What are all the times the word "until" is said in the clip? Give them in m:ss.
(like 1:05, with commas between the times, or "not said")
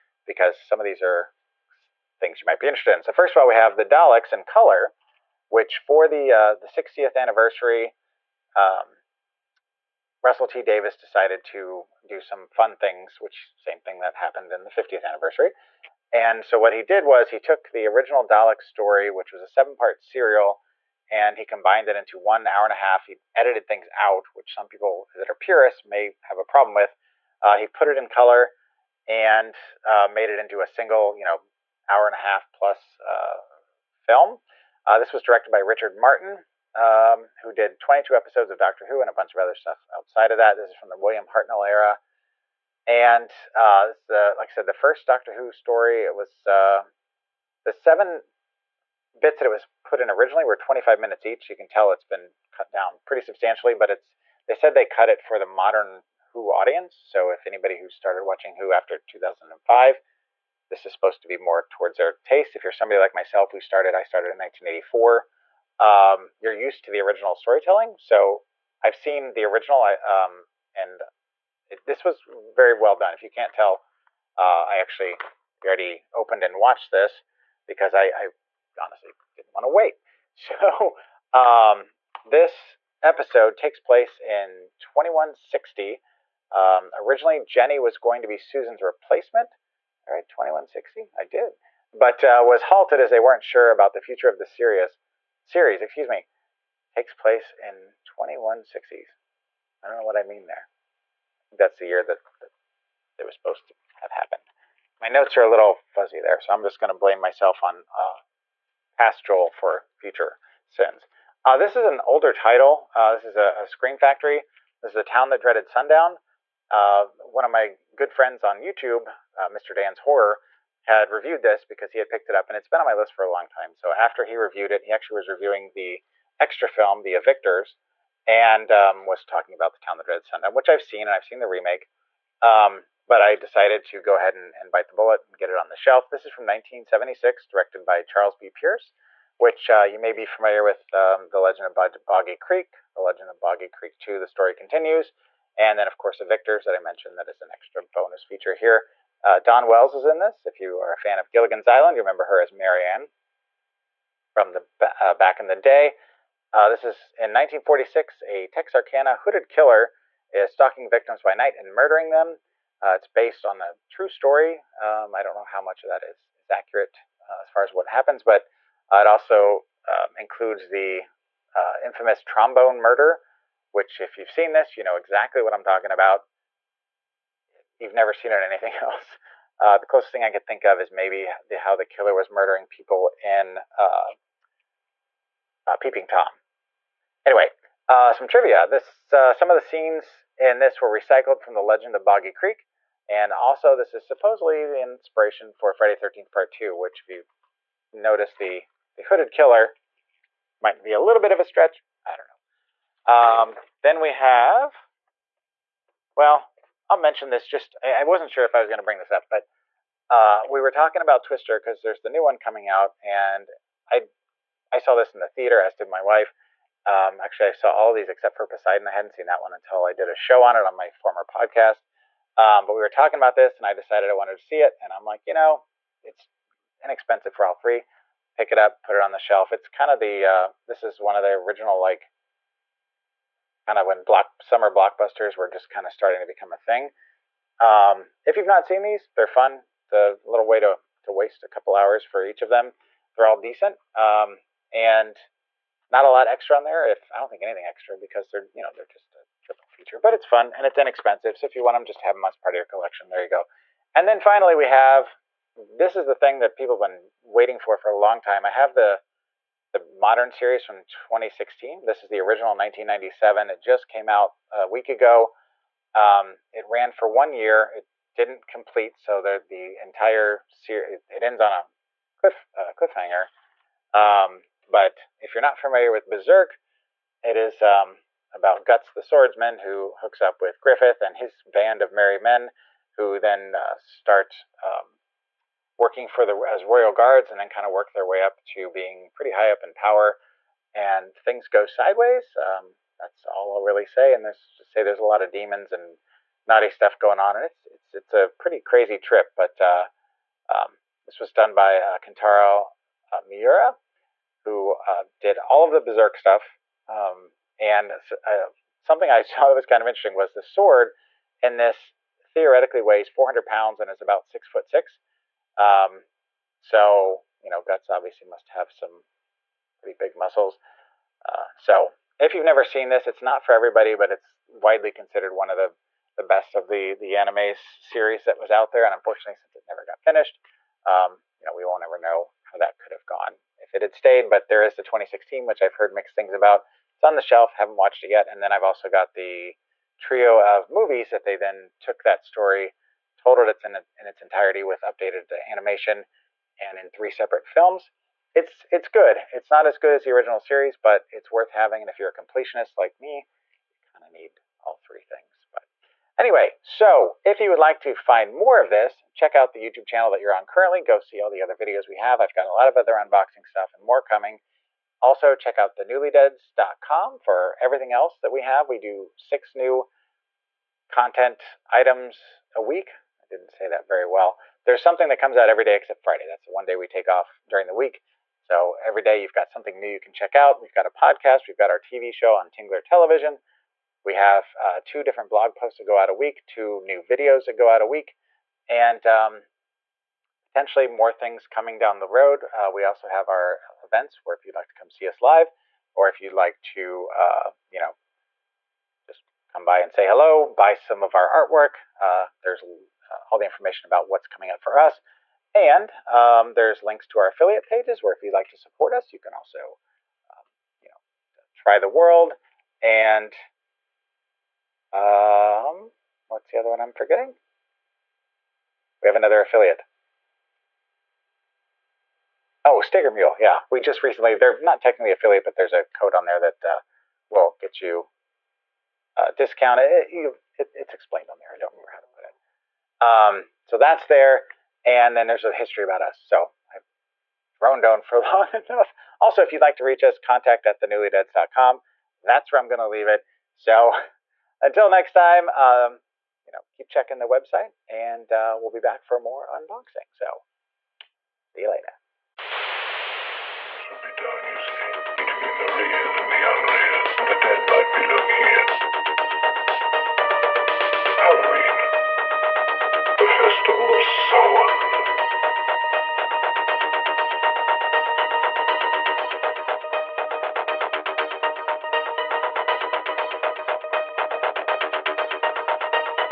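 3:39, 7:24.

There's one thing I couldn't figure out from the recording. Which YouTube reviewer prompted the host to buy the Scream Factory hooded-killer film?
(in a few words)
Mr. Dan's Horror.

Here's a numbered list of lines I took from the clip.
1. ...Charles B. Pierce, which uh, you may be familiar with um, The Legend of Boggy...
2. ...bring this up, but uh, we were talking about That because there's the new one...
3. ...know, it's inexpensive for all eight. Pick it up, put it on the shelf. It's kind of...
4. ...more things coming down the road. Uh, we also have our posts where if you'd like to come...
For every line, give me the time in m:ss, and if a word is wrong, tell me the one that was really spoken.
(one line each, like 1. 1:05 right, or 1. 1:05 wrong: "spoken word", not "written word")
1. 2:18 right
2. 3:28 wrong: "Twister", not "That"
3. 3:45 wrong: "three", not "eight"
4. 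6:30 wrong: "events", not "posts".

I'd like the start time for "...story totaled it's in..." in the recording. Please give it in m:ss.
5:42.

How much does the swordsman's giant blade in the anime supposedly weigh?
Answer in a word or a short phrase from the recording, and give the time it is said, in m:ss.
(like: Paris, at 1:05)
400 pounds, at 5:13.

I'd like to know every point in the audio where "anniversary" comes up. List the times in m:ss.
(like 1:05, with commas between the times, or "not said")
0:07, 0:15.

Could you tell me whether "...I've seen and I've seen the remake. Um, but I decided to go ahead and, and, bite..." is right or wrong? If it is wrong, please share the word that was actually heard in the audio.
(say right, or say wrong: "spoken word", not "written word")
right.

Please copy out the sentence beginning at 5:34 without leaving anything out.
But there is the 2016, which I've heard mixed things about.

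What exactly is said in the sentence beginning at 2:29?
Uh, Dawn Wells is in this.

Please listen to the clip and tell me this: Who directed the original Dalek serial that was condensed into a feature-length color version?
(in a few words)
Richard Martin.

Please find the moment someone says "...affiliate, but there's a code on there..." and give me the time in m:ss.
7:05.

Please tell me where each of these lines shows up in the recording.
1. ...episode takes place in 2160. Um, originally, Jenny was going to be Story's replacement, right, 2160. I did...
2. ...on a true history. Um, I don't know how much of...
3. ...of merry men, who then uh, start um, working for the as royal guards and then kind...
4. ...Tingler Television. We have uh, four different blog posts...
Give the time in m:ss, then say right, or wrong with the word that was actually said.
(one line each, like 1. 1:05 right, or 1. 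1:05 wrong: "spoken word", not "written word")
1. 1:23 wrong: "Susan", not "Story"
2. 2:43 wrong: "story", not "history"
3. 4:41 right
4. 6:22 wrong: "two", not "four".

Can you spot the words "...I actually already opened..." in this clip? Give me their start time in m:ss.
1:14.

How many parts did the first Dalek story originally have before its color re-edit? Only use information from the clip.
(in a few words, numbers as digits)
7.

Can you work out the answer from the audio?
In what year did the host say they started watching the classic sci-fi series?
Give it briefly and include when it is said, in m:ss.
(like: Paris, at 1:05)
1984, at 1:04.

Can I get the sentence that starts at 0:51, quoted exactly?
You can tell it's been cut down pretty substantially, but it's they said they cut it for the modern Who audience.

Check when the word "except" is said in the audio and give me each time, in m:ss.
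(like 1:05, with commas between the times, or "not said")
3:38, 6:15.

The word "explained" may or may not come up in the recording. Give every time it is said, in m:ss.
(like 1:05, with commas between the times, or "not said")
7:10.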